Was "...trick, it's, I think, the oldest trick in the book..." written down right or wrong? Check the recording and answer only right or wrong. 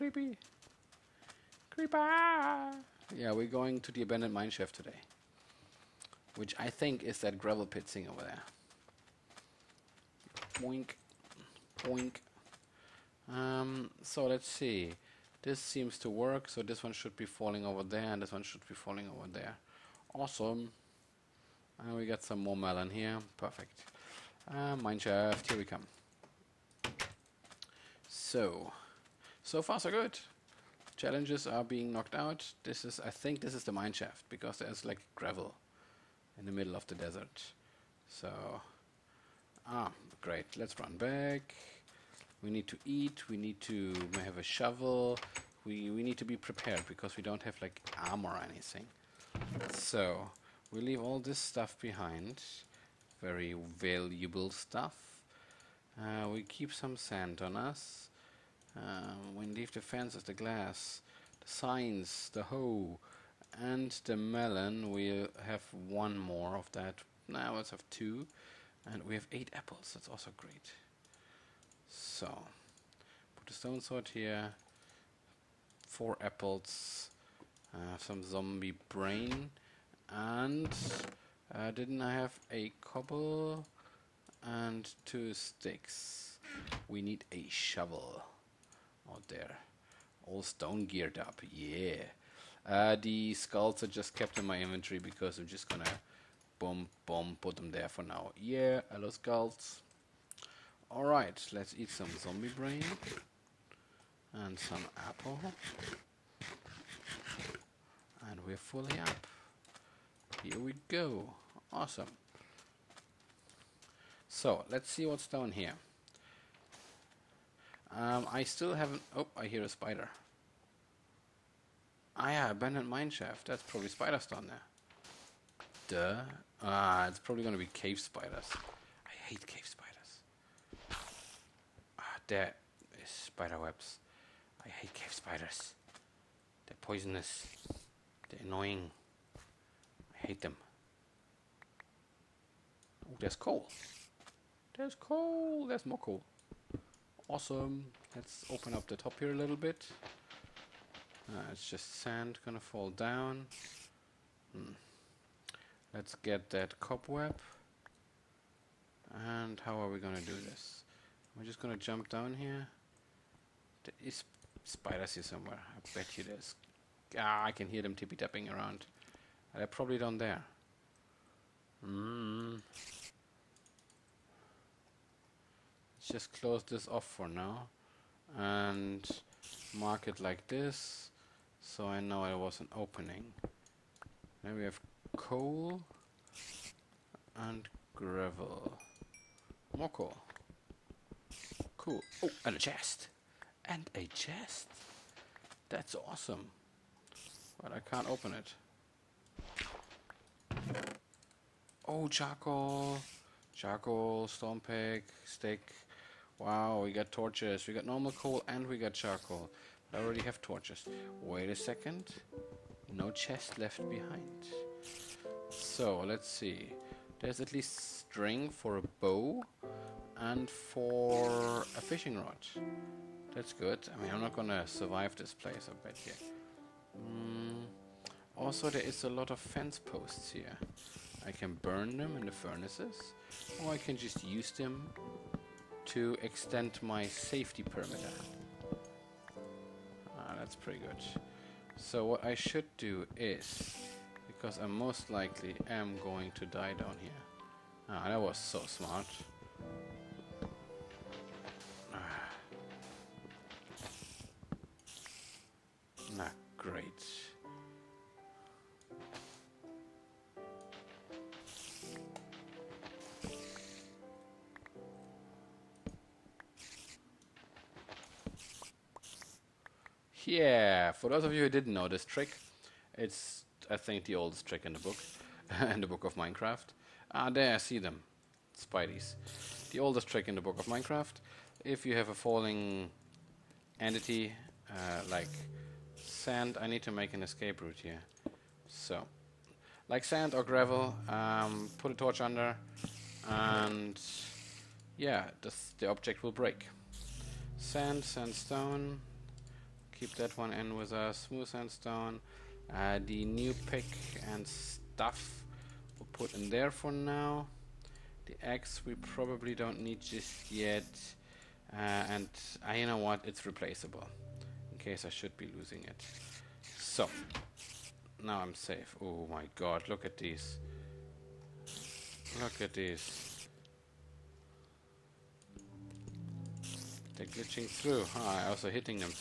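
right.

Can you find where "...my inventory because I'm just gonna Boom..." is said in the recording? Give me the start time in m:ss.
1:34.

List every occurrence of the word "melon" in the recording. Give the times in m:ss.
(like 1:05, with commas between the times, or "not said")
0:22, 1:04.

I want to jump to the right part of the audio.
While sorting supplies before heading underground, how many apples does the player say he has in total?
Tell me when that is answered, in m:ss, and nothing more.
1:09.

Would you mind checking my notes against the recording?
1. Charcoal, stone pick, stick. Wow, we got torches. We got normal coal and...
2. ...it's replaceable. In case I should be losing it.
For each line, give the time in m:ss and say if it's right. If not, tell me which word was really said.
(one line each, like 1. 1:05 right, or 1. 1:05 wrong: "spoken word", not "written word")
1. 3:23 right
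2. 5:13 right.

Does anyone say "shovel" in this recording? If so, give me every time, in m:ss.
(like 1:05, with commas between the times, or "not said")
0:44, 1:27.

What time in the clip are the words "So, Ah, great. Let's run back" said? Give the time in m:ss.
0:38.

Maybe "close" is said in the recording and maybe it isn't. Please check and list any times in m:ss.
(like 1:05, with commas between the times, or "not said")
2:56.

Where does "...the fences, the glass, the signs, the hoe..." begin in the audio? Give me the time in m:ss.
0:59.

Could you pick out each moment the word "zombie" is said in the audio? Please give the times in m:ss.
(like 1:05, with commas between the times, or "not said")
1:18, 1:42.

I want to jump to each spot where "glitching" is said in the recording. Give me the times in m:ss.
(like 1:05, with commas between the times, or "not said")
5:27.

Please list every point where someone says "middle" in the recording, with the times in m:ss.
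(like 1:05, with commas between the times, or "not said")
0:36.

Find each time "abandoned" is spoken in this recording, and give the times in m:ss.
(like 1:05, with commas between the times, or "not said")
0:04, 2:02.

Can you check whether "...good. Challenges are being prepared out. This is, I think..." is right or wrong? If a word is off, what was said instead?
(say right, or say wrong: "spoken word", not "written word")
wrong: "knocked", not "prepared".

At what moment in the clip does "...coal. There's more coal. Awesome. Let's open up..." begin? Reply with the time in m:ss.
2:24.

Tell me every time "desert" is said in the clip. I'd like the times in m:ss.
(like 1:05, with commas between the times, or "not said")
0:36.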